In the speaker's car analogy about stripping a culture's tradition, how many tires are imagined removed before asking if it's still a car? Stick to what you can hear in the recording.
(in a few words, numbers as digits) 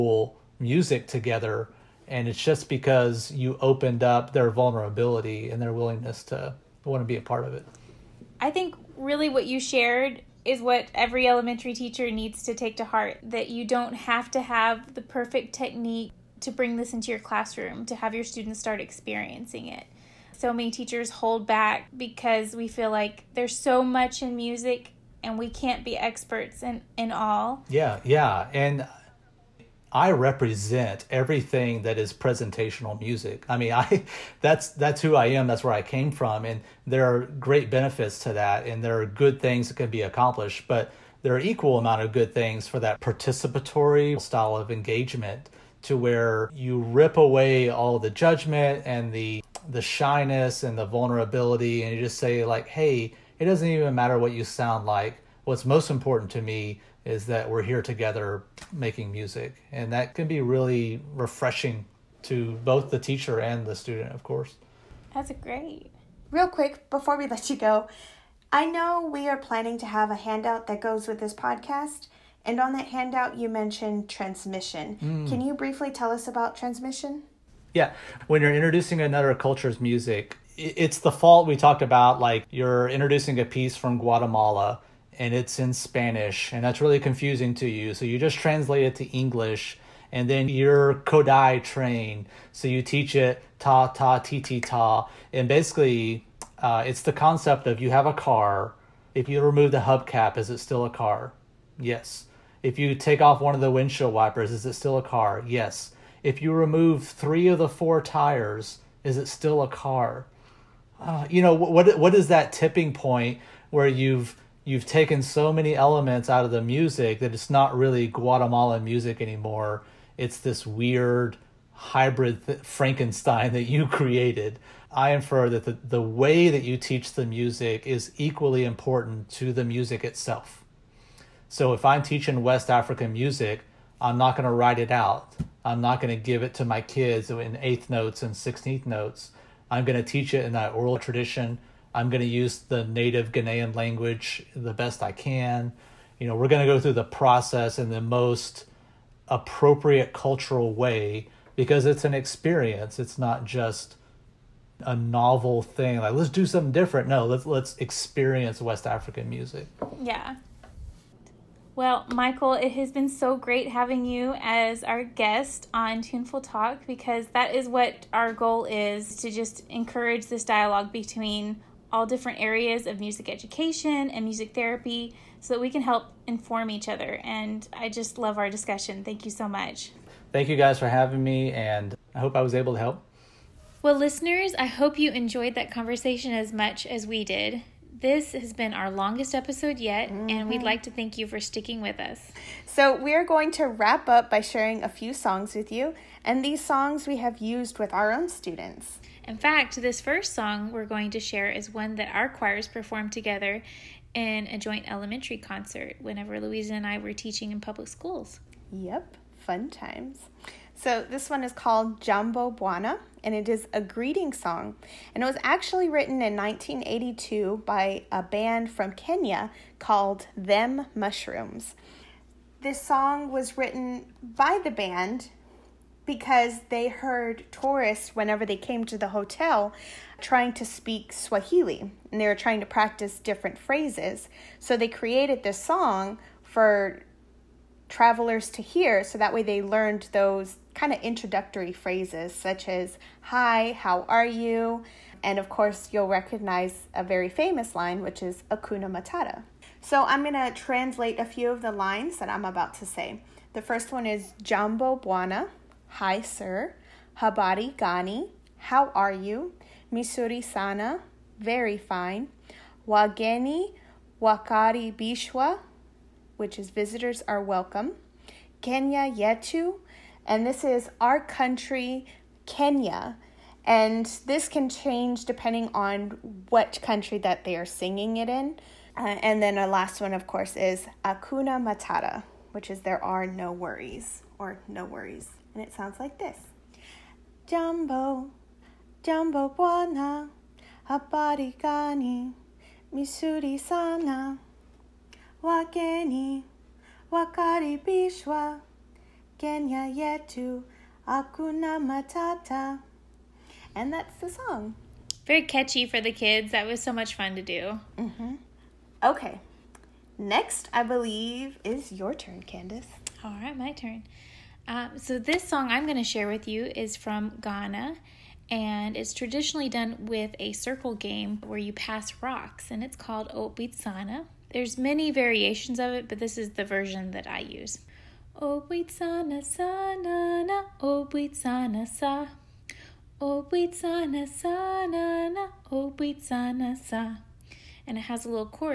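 3.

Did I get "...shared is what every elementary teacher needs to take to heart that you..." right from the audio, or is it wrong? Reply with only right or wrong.
right.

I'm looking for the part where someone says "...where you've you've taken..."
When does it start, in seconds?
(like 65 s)
113 s.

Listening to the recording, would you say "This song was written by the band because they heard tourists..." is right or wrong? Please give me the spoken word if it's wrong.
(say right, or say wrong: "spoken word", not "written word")
right.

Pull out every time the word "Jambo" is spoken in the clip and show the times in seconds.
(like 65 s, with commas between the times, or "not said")
212 s, 254 s.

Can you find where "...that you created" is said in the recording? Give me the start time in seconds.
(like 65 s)
123 s.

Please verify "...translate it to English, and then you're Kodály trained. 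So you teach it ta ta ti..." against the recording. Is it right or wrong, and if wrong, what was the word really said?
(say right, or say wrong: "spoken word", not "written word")
right.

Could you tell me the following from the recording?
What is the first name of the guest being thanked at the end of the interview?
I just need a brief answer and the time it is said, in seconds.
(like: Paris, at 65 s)
Michael, at 162 s.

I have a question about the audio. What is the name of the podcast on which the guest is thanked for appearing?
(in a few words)
Tuneful Talk.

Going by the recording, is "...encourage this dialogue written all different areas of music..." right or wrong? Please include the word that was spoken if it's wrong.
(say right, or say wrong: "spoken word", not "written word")
wrong: "between", not "written".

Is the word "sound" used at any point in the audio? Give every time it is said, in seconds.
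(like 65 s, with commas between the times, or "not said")
54 s, 285 s.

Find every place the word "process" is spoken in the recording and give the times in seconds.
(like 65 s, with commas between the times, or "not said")
147 s.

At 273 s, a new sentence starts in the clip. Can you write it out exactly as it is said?
And this can change depending on what country that they are singing it in.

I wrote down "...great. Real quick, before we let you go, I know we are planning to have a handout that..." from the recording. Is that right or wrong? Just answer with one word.
right.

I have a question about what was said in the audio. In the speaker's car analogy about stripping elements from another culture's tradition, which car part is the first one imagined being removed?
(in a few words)
hubcap.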